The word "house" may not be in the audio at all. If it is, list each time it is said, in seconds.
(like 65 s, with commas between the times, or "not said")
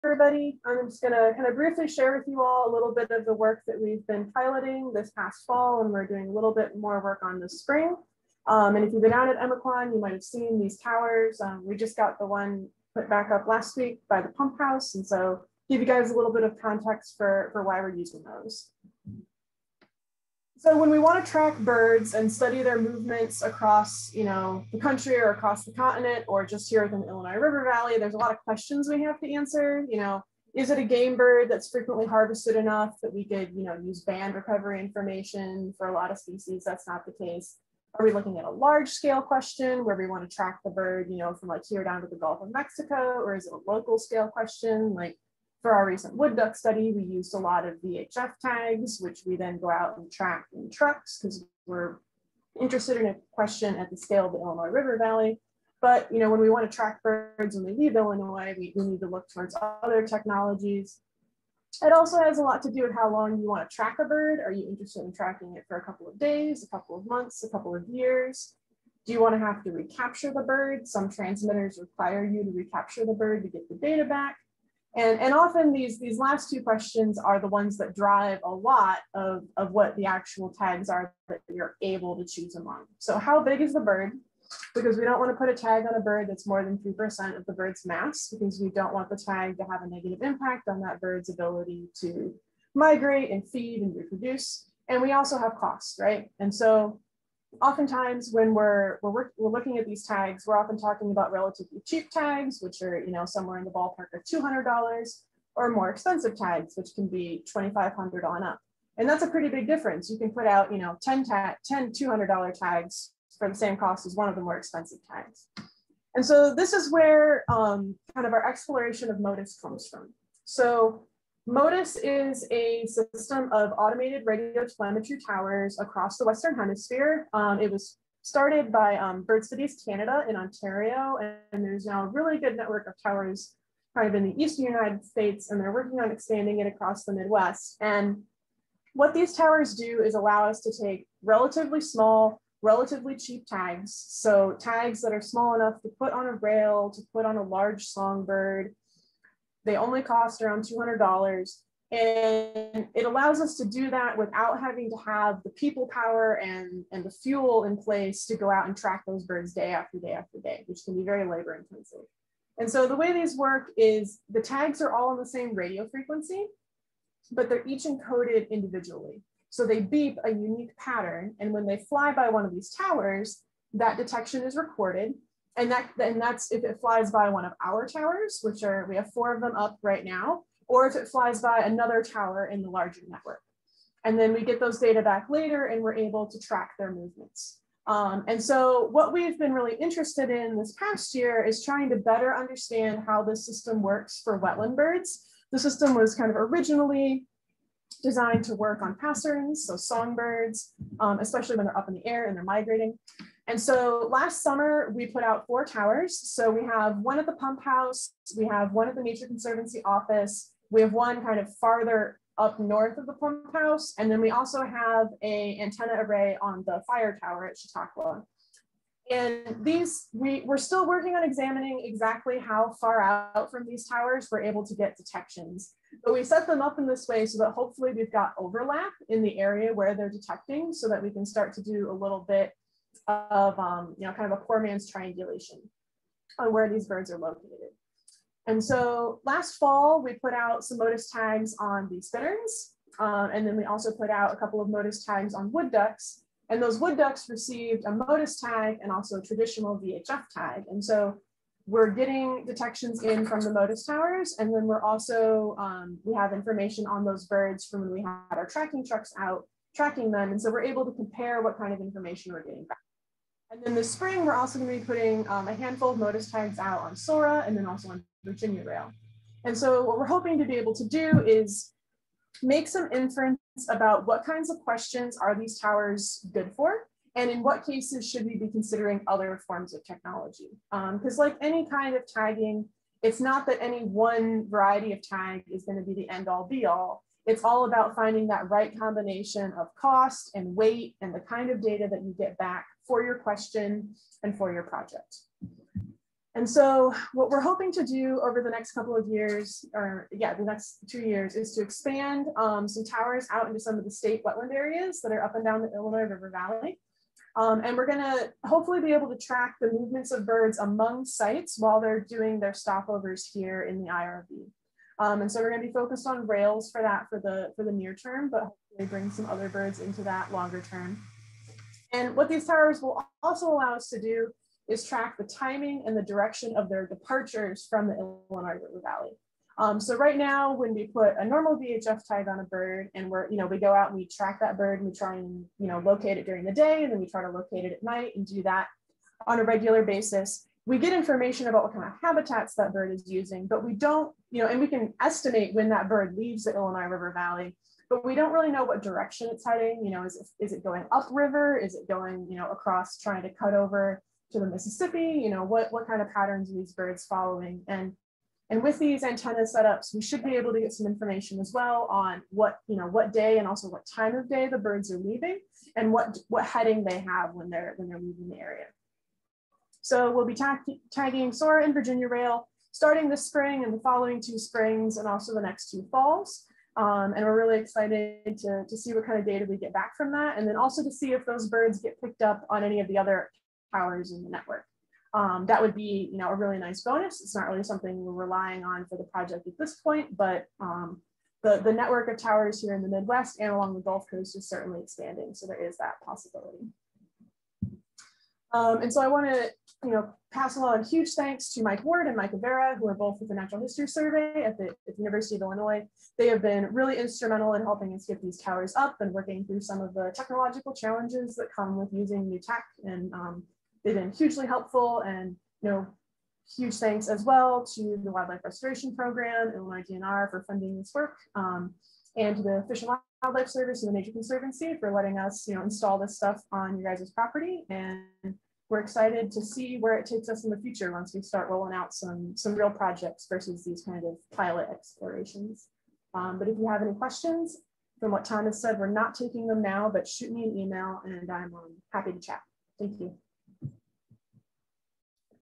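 14 s, 207 s, 213 s.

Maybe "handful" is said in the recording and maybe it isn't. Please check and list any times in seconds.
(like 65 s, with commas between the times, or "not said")
265 s.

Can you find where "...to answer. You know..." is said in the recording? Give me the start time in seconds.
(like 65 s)
29 s.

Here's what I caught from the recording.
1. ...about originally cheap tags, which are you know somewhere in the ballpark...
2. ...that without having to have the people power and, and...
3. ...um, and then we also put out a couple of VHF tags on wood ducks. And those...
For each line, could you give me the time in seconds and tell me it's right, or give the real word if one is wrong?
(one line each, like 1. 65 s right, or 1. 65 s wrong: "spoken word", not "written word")
1. 101 s wrong: "relatively", not "originally"
2. 153 s right
3. 242 s wrong: "Motus", not "VHF".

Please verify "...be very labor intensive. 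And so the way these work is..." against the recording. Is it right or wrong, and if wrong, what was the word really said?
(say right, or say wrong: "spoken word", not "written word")
right.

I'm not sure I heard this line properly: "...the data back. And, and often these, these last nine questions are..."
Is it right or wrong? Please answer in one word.
wrong.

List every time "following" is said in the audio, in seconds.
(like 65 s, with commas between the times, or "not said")
357 s, 373 s.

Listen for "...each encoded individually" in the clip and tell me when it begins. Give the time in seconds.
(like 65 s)
167 s.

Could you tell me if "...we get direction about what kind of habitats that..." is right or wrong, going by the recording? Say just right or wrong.
wrong.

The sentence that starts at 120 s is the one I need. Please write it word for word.
So Motus is a system of automated radio telemetry towers across the Western Hemisphere.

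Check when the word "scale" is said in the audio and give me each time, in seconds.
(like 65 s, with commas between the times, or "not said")
38 s, 43 s, 53 s.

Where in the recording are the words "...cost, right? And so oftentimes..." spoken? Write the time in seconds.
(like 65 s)
95 s.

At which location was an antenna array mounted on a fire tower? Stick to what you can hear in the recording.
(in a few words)
Chautauqua.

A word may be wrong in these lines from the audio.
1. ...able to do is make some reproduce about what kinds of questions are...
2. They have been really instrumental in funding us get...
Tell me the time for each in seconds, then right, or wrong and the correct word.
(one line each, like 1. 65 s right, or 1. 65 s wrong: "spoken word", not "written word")
1. 270 s wrong: "inference", not "reproduce"
2. 406 s wrong: "helping", not "funding".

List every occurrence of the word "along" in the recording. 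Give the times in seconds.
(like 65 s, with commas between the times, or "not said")
393 s, 400 s.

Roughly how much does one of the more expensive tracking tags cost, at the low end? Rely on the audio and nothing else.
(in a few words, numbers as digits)
$2,500.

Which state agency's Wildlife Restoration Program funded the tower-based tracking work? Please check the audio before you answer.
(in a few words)
Illinois DNR.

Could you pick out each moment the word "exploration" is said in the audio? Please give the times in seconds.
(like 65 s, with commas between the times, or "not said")
118 s, 434 s.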